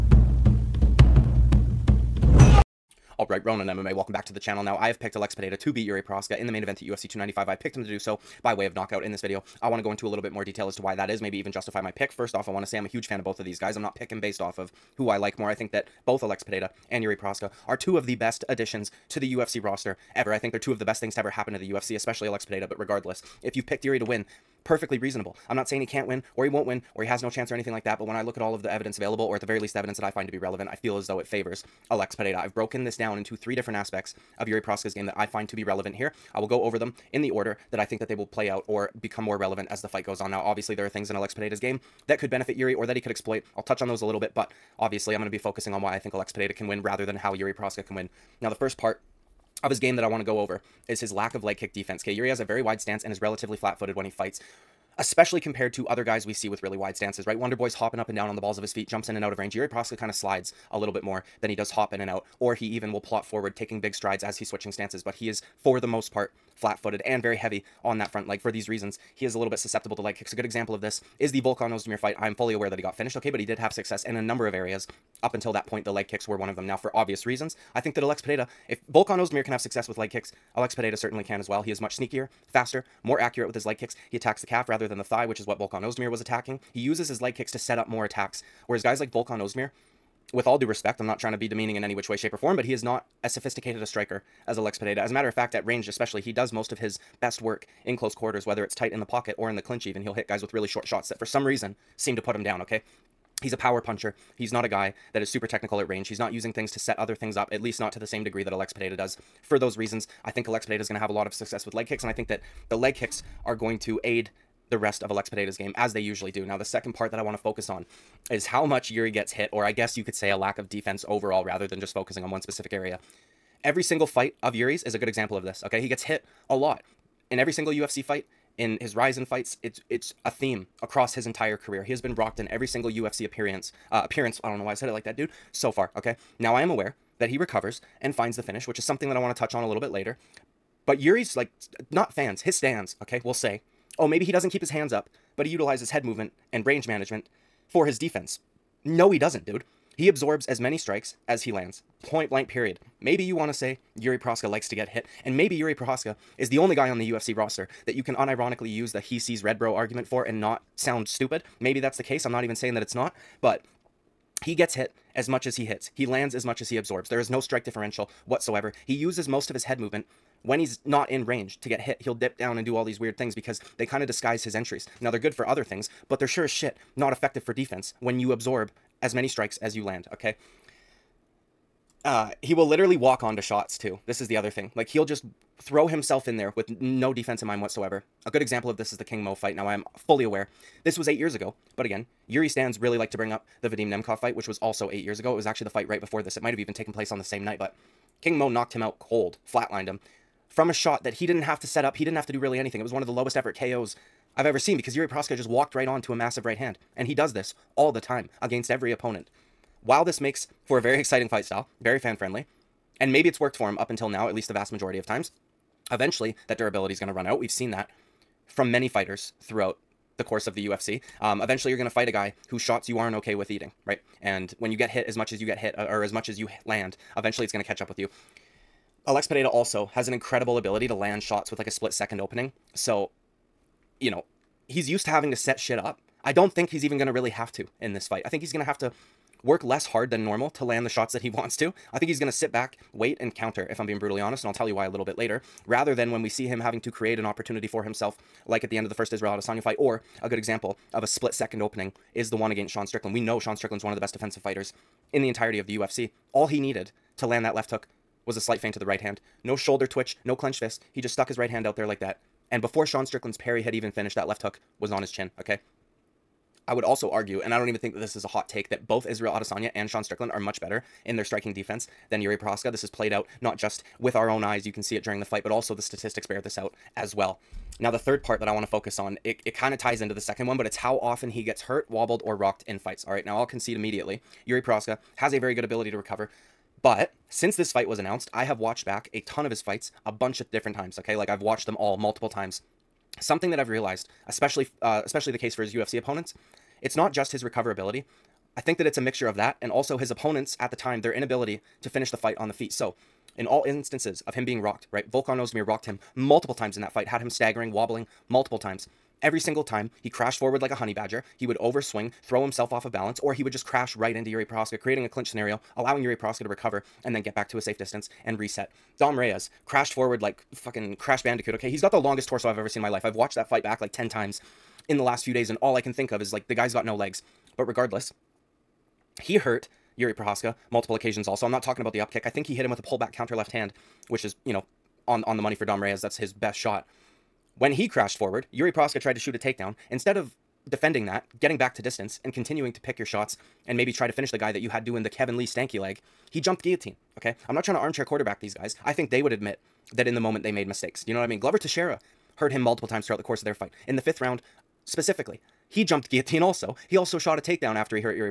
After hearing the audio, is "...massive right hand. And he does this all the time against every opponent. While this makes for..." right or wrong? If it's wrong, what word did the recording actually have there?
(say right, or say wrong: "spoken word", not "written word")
right.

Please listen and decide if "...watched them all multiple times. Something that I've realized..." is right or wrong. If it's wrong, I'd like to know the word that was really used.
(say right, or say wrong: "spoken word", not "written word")
right.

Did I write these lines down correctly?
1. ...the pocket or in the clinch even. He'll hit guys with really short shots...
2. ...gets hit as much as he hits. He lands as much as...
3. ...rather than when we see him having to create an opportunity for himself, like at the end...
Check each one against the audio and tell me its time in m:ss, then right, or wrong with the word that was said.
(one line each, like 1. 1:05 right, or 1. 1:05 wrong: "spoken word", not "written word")
1. 1:38 right
2. 2:44 right
3. 4:05 right.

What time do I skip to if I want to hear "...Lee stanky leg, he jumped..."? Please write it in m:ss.
5:45.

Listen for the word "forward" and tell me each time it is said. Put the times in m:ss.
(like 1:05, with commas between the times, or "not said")
1:03, 5:10, 5:19, 5:38.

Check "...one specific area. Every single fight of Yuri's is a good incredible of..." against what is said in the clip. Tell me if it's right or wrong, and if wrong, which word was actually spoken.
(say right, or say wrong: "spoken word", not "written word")
wrong: "example", not "incredible".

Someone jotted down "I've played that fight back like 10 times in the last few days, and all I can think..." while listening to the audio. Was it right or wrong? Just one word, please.
wrong.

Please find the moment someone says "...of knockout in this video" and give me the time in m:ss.
0:08.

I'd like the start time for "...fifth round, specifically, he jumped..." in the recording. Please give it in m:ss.
5:53.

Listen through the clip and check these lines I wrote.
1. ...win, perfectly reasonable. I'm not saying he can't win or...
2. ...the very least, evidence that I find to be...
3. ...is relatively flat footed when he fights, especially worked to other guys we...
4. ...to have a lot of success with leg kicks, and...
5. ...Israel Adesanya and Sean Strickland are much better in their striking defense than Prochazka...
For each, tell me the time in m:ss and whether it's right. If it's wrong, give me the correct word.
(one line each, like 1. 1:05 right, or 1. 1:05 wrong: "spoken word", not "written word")
1. 0:24 right
2. 0:29 right
3. 0:53 wrong: "compared", not "worked"
4. 1:50 right
5. 4:29 wrong: "Yuri", not "Prochazka".